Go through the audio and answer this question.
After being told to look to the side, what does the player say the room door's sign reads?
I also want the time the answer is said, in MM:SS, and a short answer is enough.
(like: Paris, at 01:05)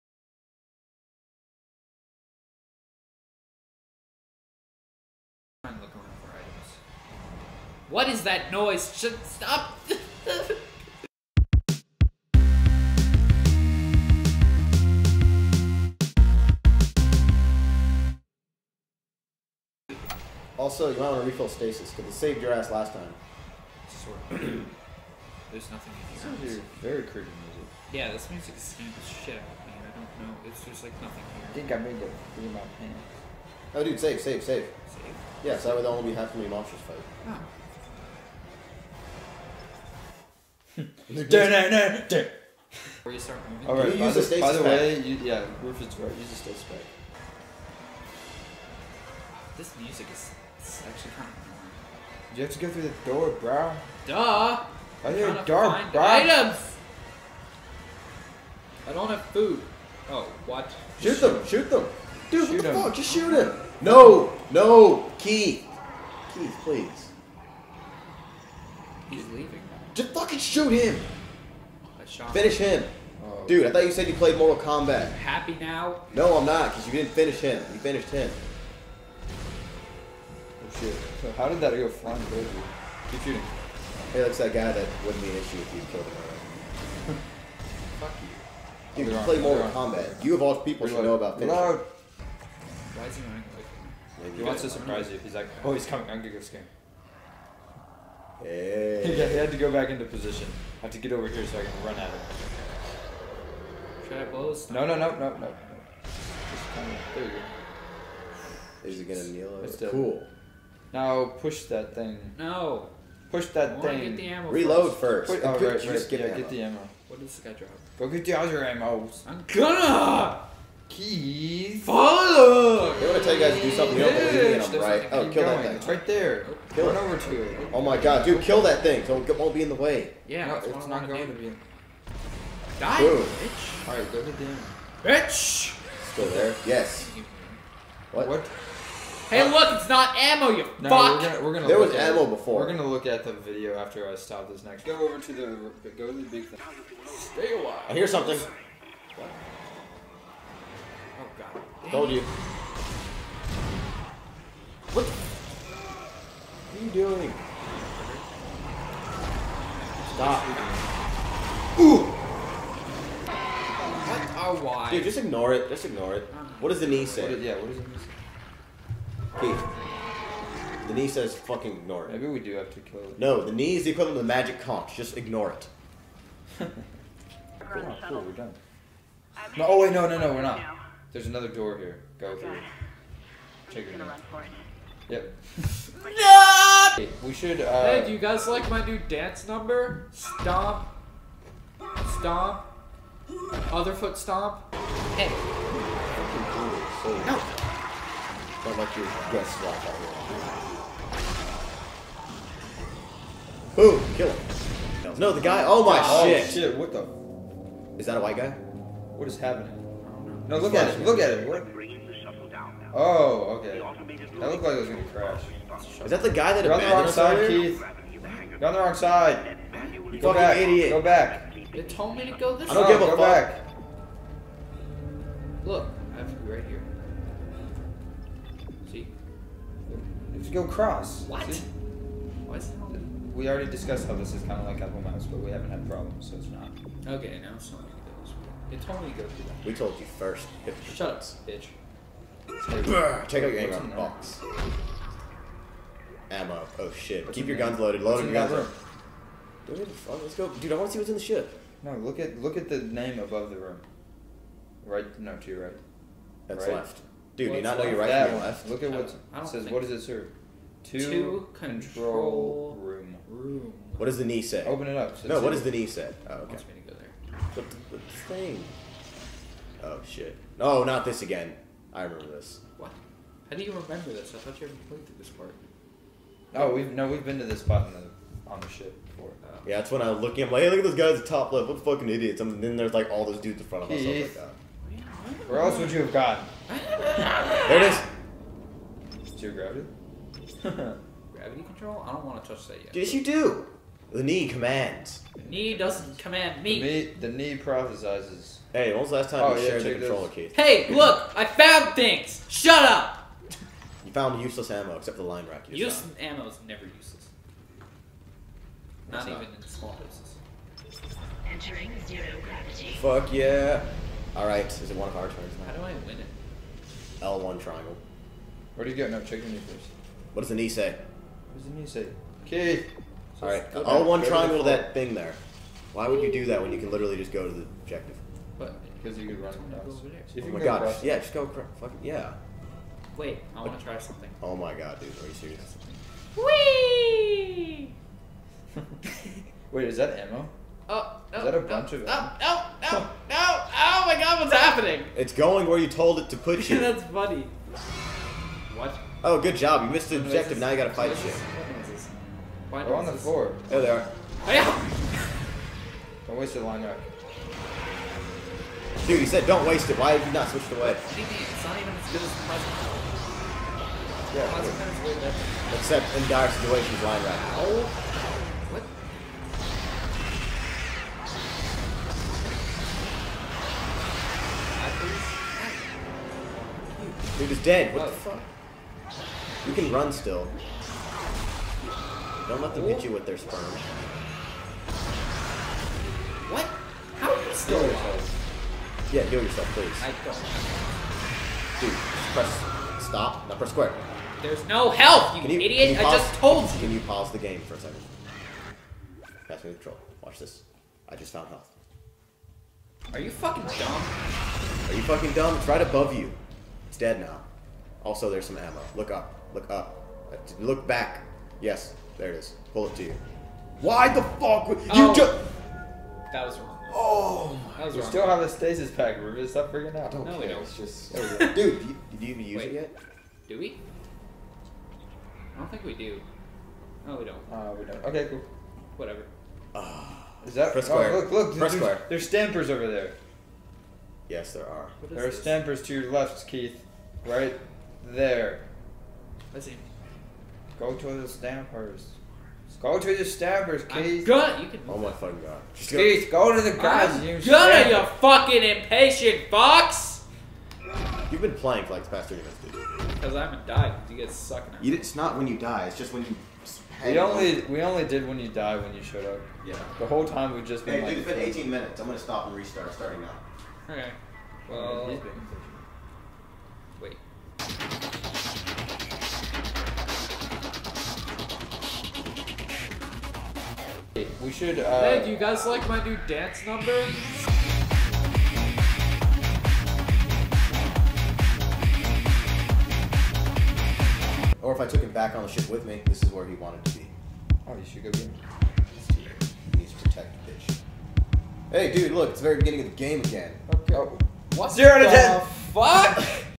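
Control room, at 04:21.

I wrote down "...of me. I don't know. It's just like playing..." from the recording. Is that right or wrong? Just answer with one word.
wrong.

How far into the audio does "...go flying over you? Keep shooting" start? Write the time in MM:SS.
01:21.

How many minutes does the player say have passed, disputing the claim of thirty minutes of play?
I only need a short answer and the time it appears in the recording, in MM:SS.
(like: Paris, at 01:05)
18, at 07:41.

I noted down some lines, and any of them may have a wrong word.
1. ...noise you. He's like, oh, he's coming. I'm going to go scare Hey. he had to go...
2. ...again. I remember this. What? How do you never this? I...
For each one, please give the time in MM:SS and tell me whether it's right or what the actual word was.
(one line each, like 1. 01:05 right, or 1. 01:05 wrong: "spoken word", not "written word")
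1. 01:34 wrong: "surprise", not "noise"
2. 04:31 wrong: "remember", not "never".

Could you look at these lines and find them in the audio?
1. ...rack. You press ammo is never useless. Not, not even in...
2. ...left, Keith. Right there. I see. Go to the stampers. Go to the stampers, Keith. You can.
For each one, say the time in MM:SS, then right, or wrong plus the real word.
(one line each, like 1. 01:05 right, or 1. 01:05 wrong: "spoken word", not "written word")
1. 05:05 wrong: "useless", not "press"
2. 07:16 right.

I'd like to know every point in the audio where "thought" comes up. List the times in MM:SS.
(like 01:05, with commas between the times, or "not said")
01:13, 04:34.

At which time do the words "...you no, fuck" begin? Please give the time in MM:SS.
02:20.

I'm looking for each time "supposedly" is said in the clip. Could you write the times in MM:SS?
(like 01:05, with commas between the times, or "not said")
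not said.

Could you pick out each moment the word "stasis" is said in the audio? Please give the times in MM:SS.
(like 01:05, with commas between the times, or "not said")
00:21, 00:46, 06:58.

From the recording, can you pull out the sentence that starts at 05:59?
Why have you not switched away?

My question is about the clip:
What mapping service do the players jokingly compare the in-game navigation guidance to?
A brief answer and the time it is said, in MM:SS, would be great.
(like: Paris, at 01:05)
Apple Maps, at 03:54.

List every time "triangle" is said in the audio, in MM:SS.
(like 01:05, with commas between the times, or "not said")
05:17, 05:24.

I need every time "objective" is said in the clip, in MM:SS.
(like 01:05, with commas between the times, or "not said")
05:27, 05:50.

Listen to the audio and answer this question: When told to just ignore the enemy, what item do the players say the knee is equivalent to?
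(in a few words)
magic conch.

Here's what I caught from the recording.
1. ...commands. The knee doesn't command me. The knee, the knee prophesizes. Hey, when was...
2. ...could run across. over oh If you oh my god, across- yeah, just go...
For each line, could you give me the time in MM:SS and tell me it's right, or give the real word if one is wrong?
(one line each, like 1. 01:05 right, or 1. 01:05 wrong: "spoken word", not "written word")
1. 04:54 right
2. 05:29 right.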